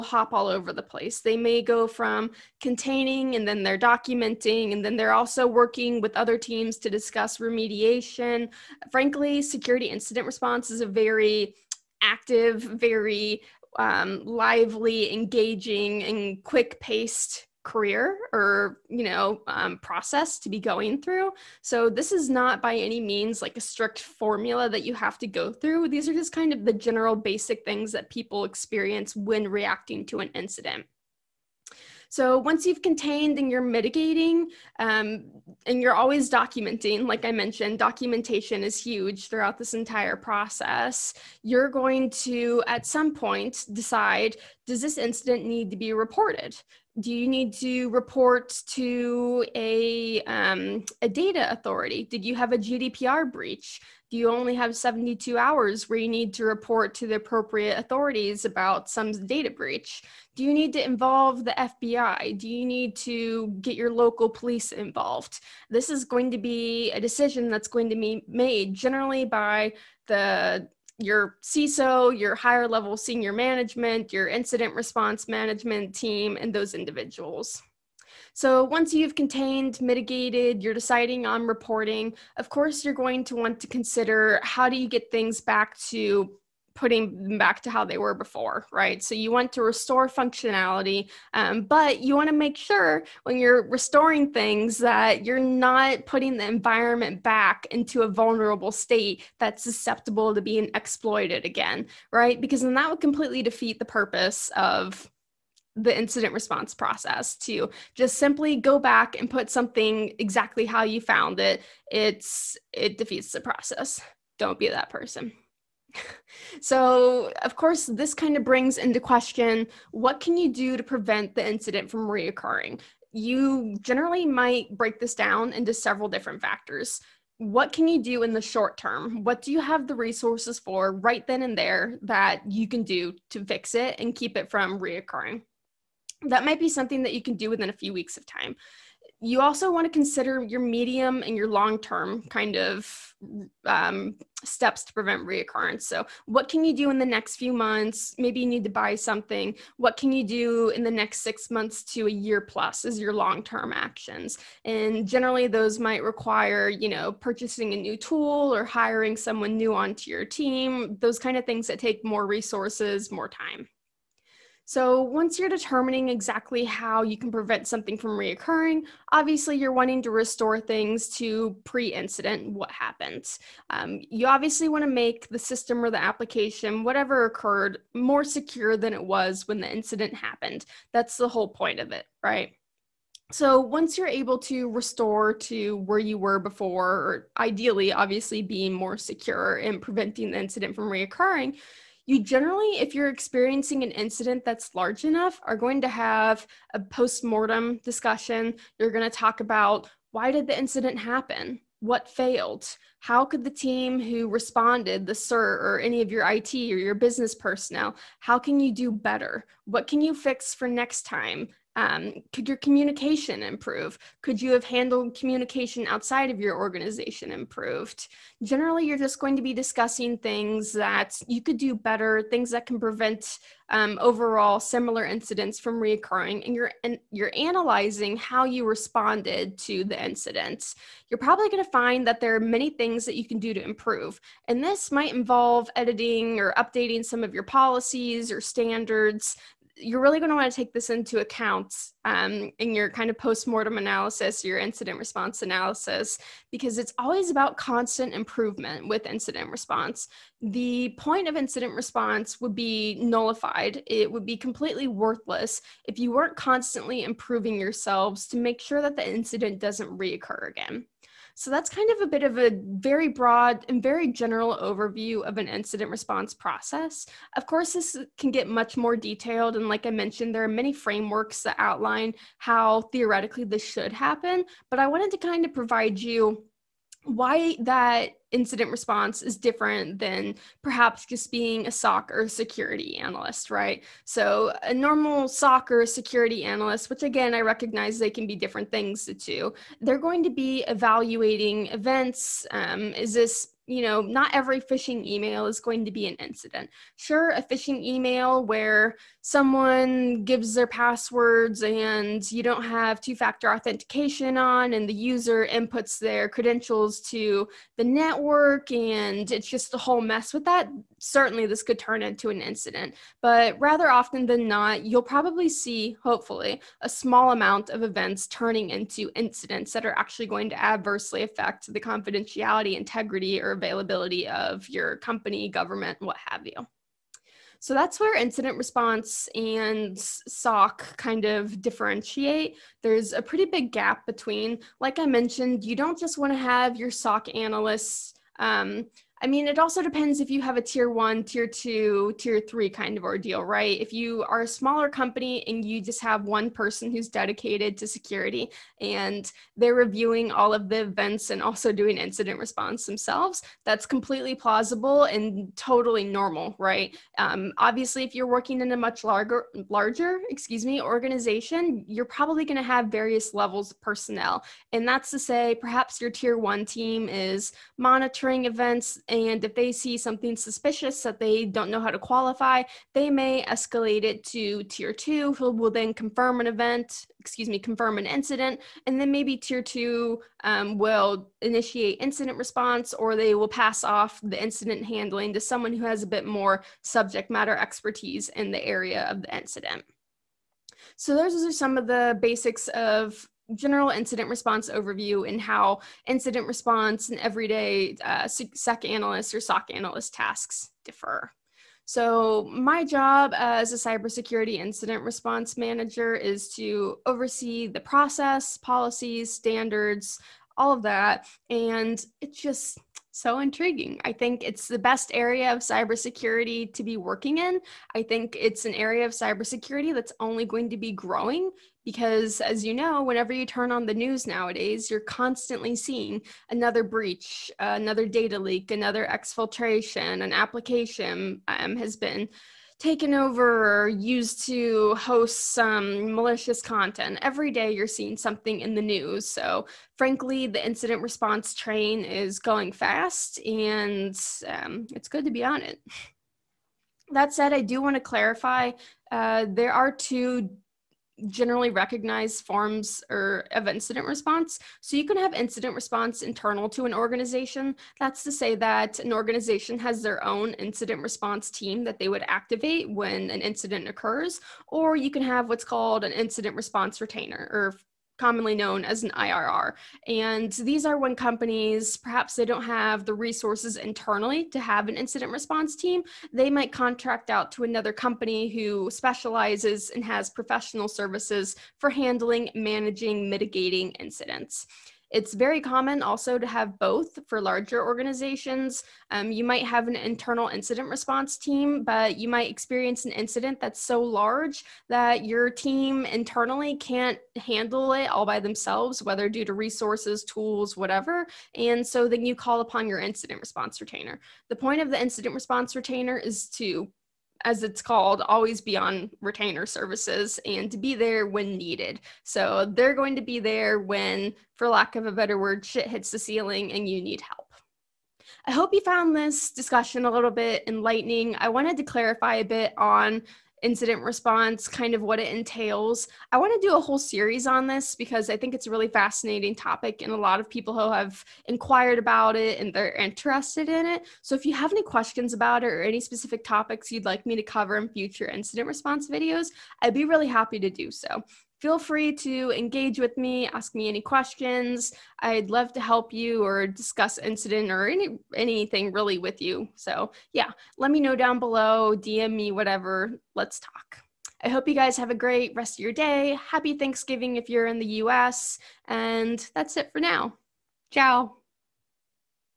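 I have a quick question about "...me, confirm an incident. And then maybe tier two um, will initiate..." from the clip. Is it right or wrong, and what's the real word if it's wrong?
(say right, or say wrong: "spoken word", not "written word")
right.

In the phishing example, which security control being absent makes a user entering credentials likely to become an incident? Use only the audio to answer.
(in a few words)
Two factor authentication.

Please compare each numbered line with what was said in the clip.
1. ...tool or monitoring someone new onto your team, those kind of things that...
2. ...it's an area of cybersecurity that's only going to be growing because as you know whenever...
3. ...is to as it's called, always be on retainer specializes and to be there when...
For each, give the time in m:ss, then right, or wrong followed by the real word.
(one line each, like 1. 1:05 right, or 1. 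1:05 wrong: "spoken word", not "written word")
1. 2:37 wrong: "hiring", not "monitoring"
2. 6:58 right
3. 8:26 wrong: "services", not "specializes".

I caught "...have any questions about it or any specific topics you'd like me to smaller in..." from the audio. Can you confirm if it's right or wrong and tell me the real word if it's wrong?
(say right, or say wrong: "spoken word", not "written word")
wrong: "cover", not "smaller".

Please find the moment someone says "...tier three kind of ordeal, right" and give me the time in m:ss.
5:42.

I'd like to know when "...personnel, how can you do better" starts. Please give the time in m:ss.
3:27.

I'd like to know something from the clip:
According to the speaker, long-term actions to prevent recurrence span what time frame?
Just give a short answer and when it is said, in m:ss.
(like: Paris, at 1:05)
Six months to a year plus, at 2:31.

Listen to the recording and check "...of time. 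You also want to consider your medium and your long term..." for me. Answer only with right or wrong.
right.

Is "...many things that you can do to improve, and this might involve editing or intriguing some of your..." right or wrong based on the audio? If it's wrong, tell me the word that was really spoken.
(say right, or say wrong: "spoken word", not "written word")
wrong: "updating", not "intriguing".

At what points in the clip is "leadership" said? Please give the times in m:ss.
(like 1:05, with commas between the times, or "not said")
not said.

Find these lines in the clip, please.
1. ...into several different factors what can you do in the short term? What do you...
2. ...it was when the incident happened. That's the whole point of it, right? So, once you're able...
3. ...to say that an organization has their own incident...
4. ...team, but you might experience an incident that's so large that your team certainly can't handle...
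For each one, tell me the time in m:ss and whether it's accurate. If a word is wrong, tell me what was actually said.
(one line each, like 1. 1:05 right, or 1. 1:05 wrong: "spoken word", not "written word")
1. 2:05 right
2. 2:58 right
3. 7:38 right
4. 8:11 wrong: "internally", not "certainly".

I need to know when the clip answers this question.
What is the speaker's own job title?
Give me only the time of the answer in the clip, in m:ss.
6:43.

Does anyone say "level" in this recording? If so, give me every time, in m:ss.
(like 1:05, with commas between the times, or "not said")
1:12, 6:03.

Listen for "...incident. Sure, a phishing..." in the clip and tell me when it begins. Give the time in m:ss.
4:56.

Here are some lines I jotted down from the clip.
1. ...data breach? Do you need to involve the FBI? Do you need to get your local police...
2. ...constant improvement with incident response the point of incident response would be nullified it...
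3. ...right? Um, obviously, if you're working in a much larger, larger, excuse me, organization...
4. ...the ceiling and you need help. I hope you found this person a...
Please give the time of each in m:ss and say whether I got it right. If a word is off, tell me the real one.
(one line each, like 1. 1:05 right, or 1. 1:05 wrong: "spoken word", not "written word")
1. 0:59 right
2. 4:07 right
3. 5:56 right
4. 8:36 wrong: "discussion", not "person".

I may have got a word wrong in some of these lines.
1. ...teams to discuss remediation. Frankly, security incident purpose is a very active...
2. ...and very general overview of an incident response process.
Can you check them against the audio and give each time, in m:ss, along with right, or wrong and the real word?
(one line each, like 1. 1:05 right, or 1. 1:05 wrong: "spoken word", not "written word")
1. 0:06 wrong: "response", not "purpose"
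2. 4:23 right.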